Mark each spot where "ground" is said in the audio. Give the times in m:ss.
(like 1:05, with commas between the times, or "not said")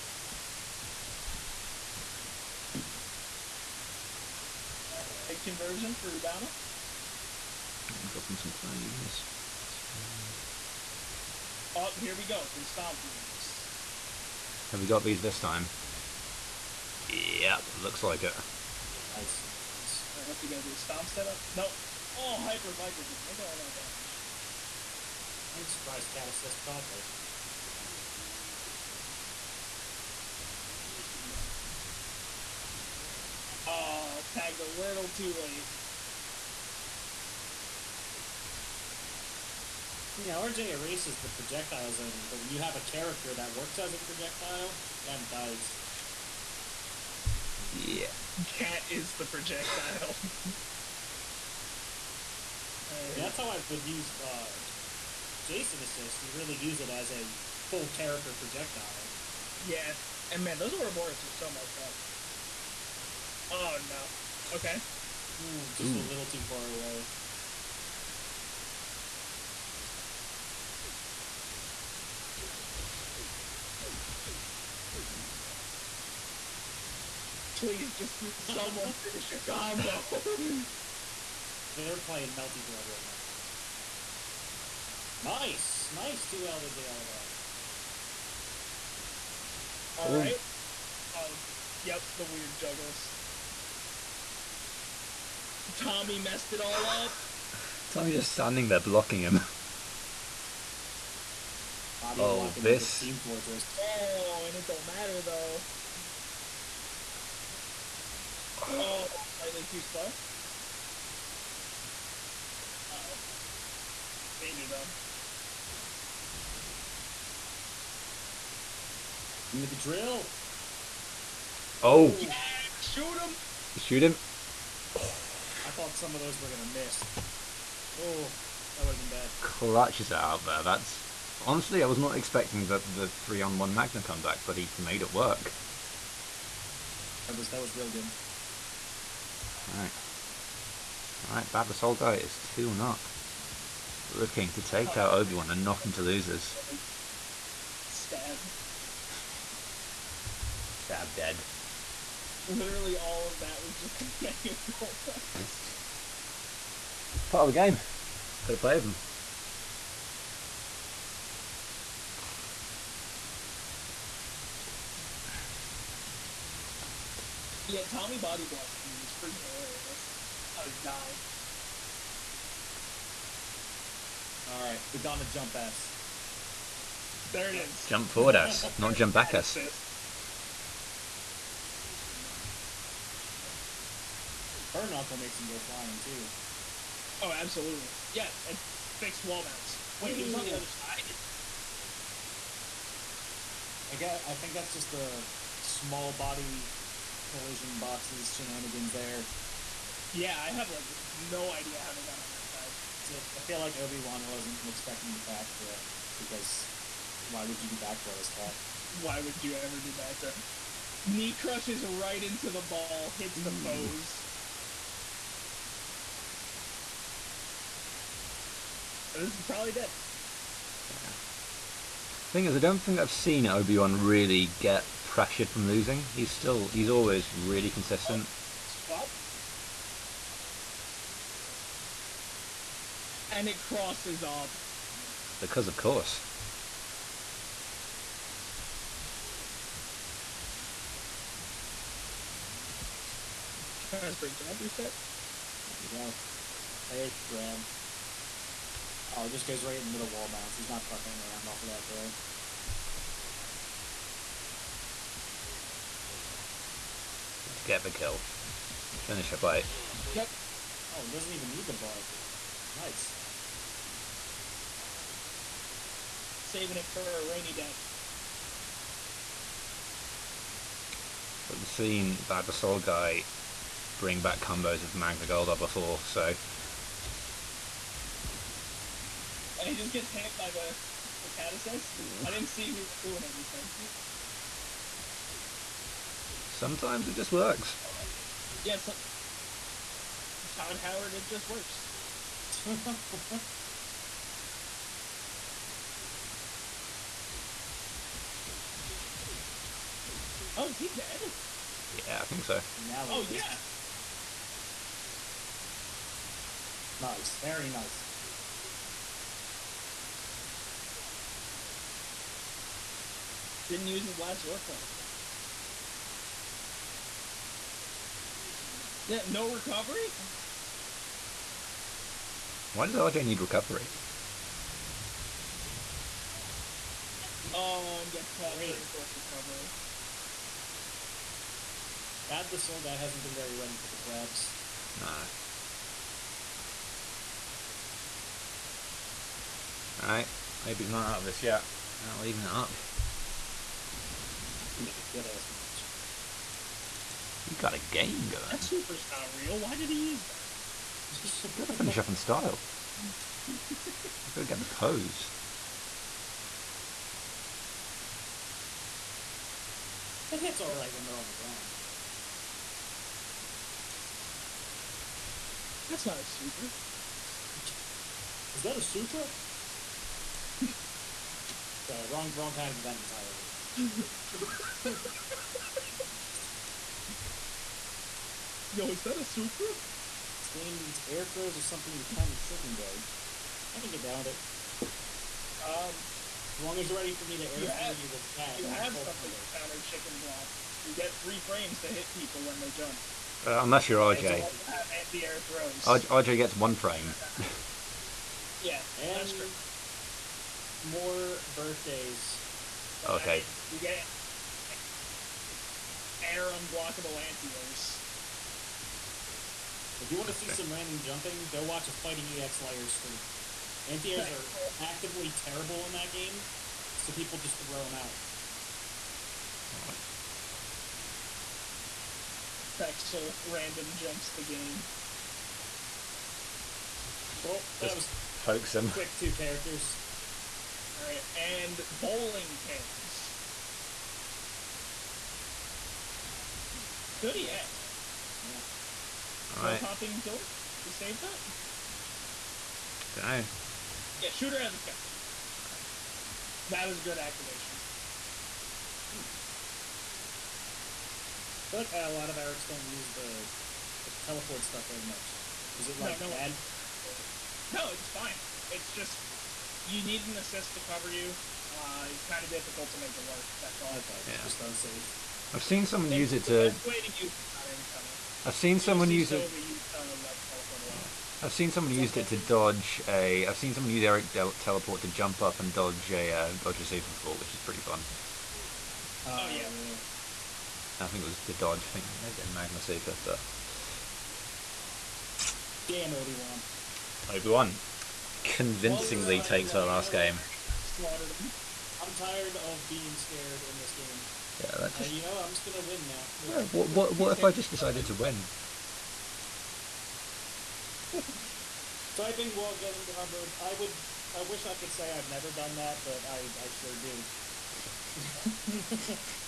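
6:01.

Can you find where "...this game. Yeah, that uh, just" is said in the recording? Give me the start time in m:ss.
8:13.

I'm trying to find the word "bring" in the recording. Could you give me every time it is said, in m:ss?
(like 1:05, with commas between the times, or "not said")
4:33.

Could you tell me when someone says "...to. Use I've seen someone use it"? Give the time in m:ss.
7:46.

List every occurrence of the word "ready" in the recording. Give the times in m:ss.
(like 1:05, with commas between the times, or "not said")
5:33, 6:26.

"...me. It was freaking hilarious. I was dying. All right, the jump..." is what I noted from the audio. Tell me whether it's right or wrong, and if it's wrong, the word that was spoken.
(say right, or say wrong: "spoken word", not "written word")
right.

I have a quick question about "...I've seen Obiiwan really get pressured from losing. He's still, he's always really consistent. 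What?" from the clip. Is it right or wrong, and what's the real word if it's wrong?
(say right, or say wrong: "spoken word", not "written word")
right.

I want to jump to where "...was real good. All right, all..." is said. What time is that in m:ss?
2:17.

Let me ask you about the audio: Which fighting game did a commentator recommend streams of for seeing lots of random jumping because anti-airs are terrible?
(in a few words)
Fighting EX Layer.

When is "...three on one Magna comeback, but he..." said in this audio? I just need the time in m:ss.
2:13.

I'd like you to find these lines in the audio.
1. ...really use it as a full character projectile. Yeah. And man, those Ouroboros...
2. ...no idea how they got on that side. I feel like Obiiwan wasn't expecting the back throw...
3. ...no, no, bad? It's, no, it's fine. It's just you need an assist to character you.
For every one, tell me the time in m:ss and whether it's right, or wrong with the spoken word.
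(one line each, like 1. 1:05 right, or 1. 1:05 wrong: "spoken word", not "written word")
1. 0:56 right
2. 3:21 right
3. 7:36 wrong: "cover", not "character".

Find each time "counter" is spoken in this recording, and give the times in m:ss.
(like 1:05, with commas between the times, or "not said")
6:22, 6:29.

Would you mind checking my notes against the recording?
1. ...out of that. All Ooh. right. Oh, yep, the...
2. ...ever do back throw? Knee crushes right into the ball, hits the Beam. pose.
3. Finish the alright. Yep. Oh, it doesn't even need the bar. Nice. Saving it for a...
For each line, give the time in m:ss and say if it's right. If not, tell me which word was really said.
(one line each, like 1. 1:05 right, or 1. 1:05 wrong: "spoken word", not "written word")
1. 1:26 right
2. 3:29 wrong: "Ooh", not "Beam"
3. 4:19 wrong: "fight", not "alright".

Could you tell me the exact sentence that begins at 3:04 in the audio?
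Her knuckle makes him go flying too.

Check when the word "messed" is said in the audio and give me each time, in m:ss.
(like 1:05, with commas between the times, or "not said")
1:01, 1:36.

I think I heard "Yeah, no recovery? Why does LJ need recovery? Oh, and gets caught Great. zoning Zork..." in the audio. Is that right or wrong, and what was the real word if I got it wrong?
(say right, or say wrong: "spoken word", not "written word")
wrong: "during", not "zoning".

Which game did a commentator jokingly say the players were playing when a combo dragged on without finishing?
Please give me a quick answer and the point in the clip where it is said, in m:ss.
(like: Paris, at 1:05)
Melty Blood, at 1:22.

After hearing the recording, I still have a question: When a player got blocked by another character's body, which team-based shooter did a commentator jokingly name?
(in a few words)
Team Fortress.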